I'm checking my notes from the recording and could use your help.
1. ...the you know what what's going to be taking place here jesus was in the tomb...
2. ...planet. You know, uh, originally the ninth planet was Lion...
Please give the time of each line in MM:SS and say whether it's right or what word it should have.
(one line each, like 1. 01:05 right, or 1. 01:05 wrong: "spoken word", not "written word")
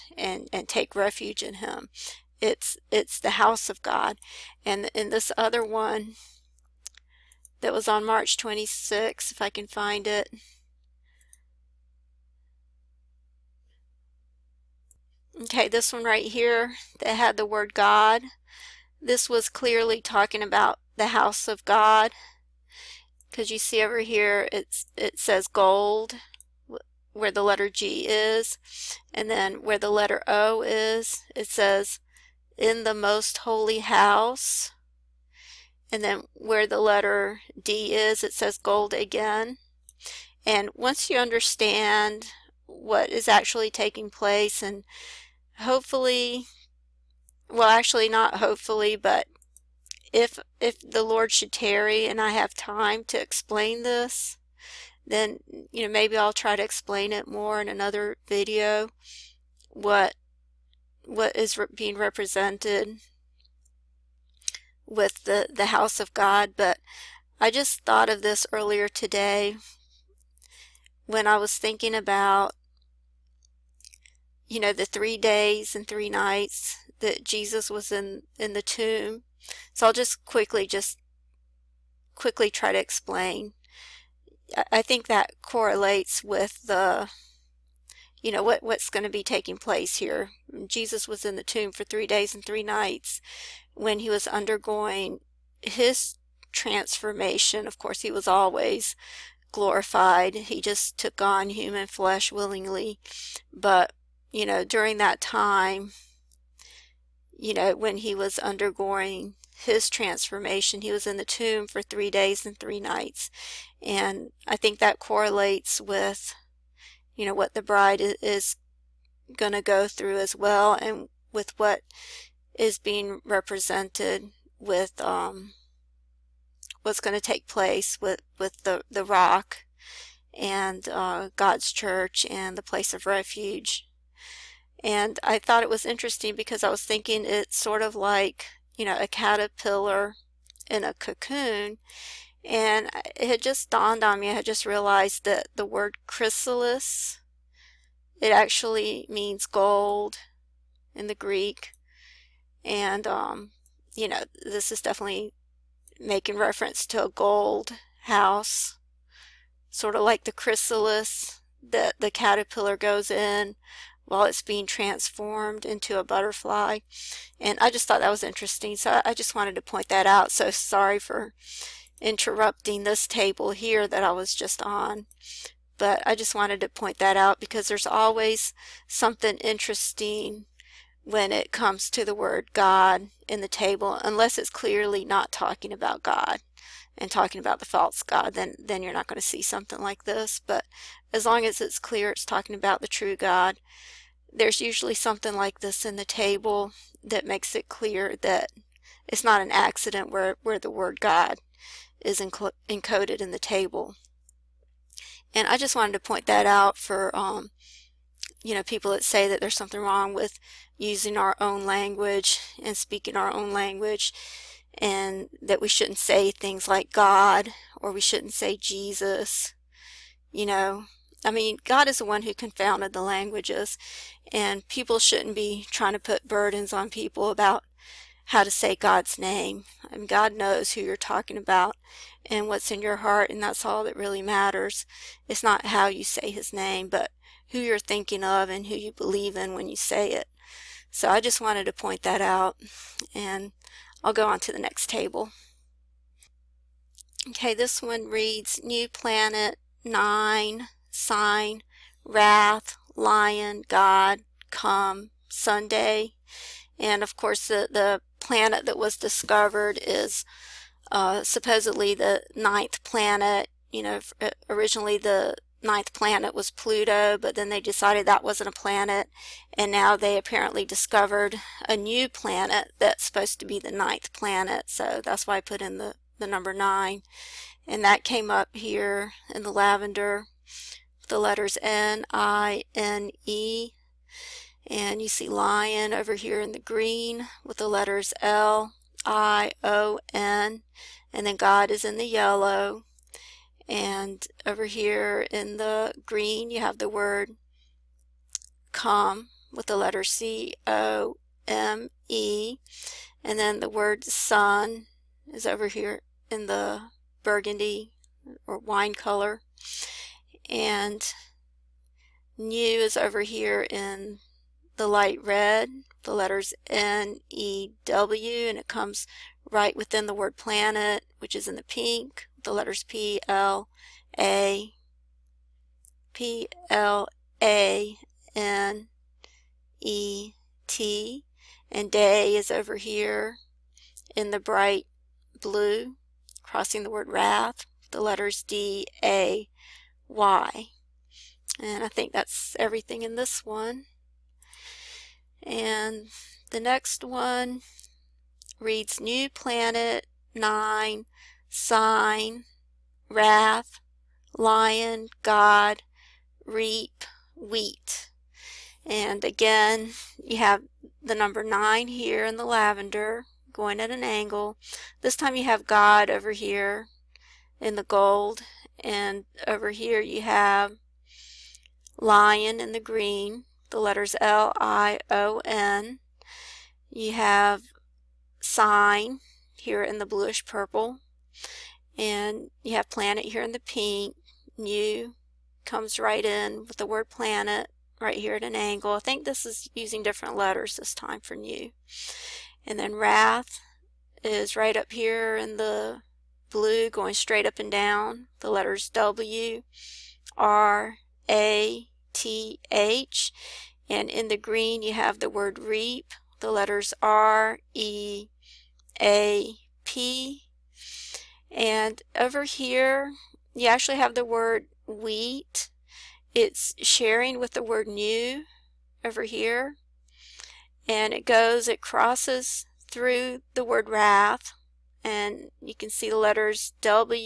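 1. 01:26 right
2. 04:22 wrong: "Pluto", not "Lion".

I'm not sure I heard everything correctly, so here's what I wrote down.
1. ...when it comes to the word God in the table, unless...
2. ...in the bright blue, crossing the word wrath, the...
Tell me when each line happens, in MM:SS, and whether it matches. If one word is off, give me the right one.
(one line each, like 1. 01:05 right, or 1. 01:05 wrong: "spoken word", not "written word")
1. 03:01 right
2. 05:34 right.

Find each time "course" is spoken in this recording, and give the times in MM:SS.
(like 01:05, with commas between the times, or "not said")
01:37, 04:17.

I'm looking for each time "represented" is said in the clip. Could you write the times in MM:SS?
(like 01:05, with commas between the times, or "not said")
01:01, 02:03.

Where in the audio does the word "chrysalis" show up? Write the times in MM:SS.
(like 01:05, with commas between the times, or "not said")
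02:26, 02:40.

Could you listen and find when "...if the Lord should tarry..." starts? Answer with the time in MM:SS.
00:50.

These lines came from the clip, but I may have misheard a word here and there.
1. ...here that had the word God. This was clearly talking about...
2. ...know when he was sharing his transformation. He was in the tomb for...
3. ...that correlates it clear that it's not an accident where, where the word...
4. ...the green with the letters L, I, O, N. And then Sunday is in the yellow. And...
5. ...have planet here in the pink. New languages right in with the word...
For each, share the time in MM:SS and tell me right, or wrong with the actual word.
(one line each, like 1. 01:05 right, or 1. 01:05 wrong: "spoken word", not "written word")
1. 00:16 right
2. 01:47 wrong: "undergoing", not "sharing"
3. 03:17 wrong: "makes", not "correlates"
4. 04:46 wrong: "God", not "Sunday"
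5. 06:22 wrong: "comes", not "languages".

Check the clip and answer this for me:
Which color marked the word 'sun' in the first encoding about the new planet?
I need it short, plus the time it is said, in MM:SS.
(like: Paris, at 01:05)
burgundy, at 05:07.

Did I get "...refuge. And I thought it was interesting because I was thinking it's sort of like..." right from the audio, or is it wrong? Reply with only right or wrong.
right.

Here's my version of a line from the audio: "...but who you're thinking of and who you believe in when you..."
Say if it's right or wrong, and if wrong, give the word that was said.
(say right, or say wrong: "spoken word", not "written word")
right.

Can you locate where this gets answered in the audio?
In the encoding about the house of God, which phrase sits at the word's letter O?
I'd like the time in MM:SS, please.
00:32.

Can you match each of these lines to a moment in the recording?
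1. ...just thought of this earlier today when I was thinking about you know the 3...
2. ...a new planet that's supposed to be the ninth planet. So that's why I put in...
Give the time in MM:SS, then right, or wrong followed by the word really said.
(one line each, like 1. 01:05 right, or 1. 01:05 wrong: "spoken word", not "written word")
1. 01:07 right
2. 04:31 right.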